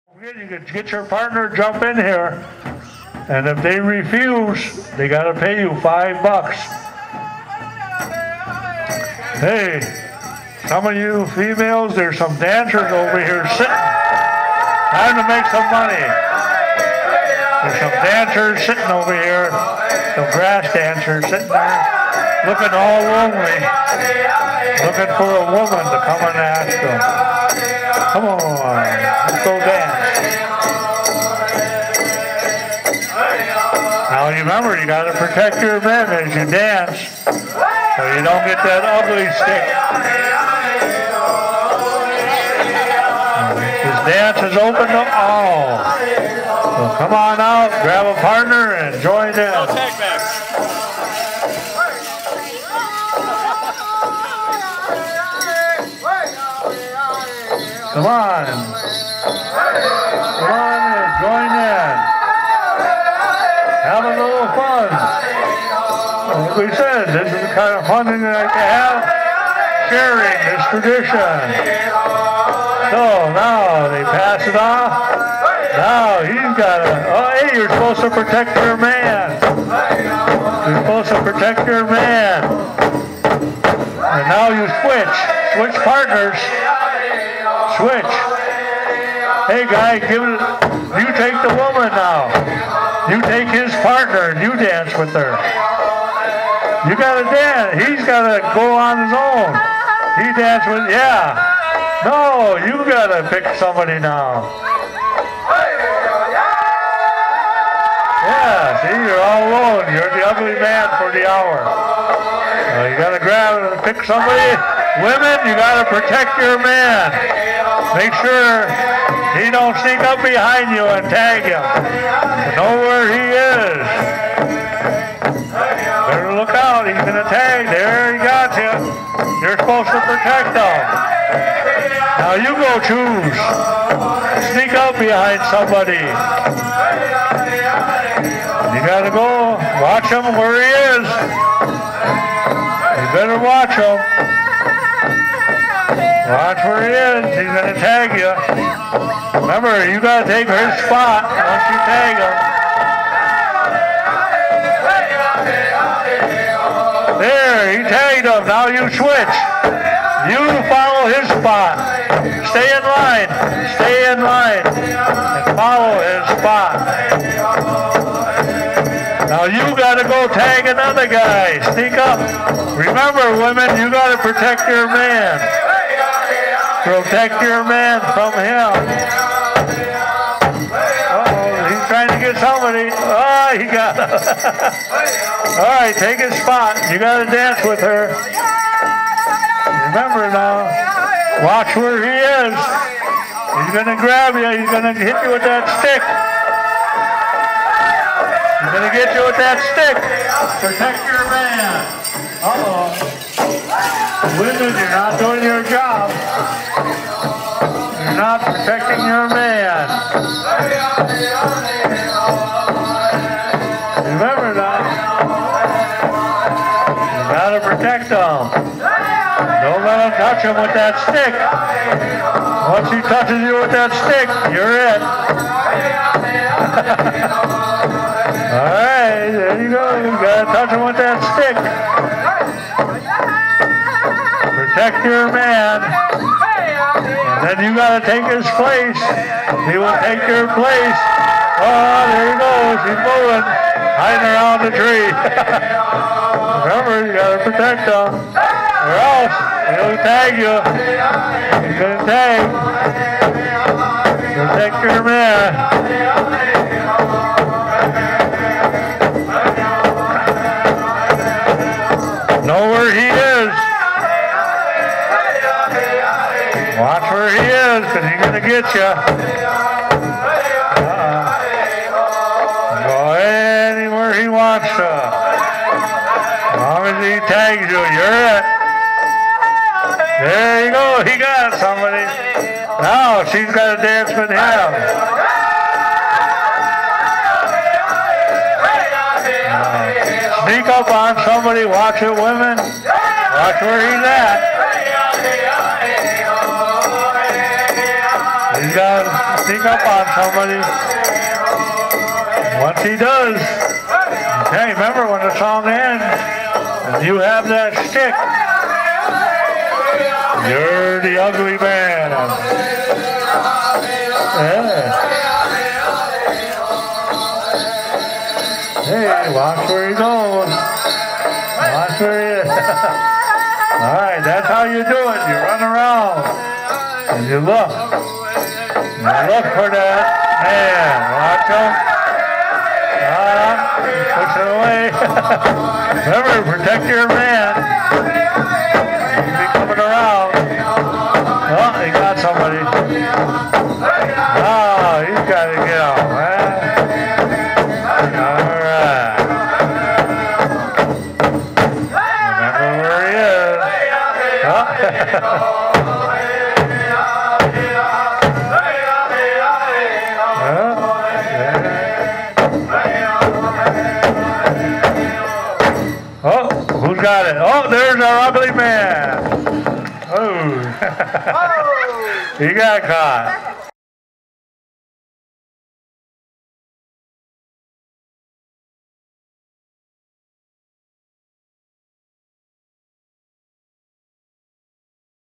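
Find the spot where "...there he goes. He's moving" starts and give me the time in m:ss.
4:02.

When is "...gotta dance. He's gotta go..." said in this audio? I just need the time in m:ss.
1:36.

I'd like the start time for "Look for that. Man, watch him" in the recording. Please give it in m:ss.
5:29.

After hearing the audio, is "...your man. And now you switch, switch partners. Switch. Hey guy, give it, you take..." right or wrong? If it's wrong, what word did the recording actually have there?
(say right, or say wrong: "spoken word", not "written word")
right.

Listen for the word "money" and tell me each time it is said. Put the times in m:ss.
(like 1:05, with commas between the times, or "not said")
0:15.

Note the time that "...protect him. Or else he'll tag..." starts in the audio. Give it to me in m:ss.
4:07.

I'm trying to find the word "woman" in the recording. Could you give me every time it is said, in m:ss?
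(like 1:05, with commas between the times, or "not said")
0:25, 1:31.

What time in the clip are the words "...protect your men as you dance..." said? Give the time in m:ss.
0:35.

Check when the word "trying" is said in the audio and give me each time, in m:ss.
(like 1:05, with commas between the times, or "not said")
0:14, 3:02.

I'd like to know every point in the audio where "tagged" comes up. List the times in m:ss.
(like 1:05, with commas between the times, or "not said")
2:37.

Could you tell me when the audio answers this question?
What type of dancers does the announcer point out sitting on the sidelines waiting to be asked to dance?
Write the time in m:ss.
0:20.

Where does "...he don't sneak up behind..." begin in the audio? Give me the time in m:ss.
1:59.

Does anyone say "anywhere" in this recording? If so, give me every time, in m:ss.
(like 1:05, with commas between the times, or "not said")
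4:33.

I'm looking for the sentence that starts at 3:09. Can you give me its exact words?
Remember now, watch where he is.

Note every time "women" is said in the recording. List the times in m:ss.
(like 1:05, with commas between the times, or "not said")
1:55, 2:53, 3:24, 4:52.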